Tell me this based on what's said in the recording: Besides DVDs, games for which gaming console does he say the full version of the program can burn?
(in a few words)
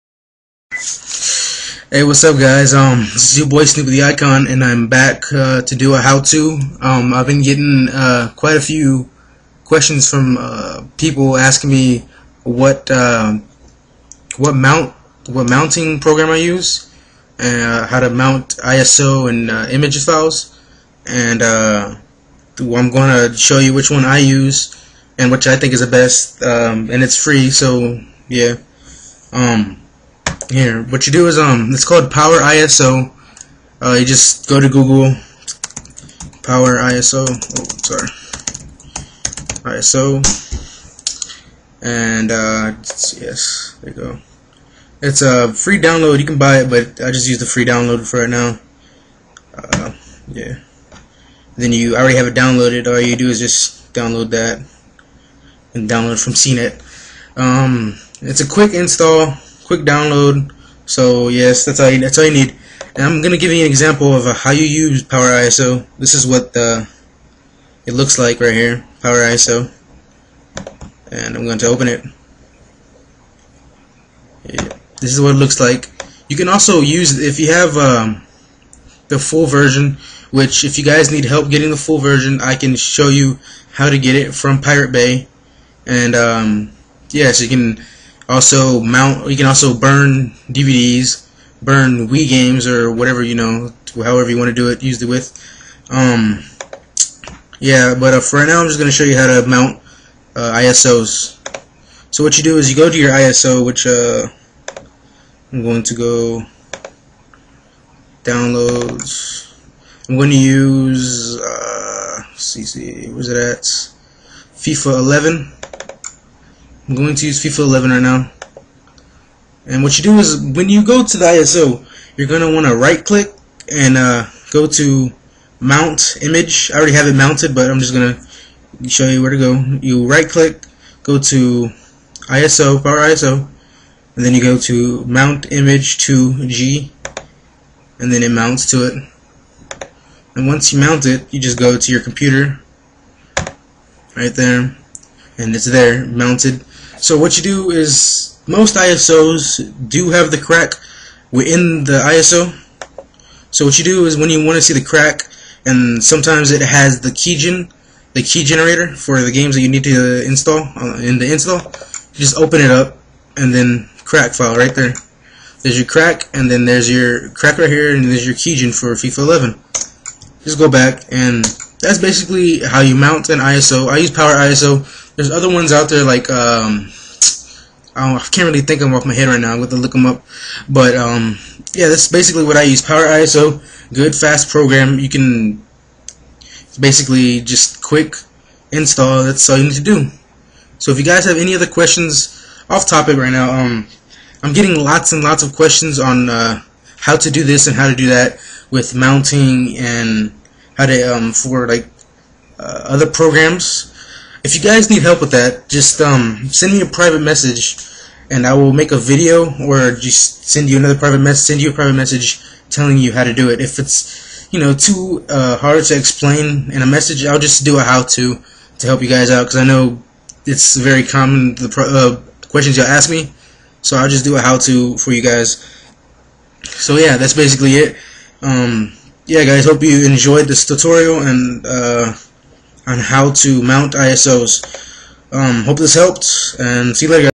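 Wii.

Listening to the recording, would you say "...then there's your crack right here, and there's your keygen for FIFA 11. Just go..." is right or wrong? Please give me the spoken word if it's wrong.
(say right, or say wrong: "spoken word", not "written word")
right.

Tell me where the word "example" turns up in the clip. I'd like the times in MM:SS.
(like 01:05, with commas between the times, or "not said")
01:03.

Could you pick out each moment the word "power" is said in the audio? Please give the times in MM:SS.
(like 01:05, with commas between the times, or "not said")
00:32, 00:36, 01:05, 01:09, 02:12, 02:54, 03:02.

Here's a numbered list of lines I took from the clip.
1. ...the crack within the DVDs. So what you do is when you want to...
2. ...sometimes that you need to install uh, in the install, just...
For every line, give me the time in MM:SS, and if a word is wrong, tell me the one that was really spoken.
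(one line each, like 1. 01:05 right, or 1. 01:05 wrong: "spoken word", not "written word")
1. 02:30 wrong: "ISO", not "DVDs"
2. 02:39 wrong: "games", not "sometimes".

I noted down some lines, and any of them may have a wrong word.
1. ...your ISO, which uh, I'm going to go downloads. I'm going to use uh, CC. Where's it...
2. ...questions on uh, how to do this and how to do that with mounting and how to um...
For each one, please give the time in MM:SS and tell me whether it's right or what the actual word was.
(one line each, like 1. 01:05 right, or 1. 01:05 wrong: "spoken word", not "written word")
1. 01:42 right
2. 03:15 right.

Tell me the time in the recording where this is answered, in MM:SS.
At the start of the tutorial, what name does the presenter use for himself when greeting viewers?
00:03.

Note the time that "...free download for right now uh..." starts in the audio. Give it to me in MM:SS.
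00:47.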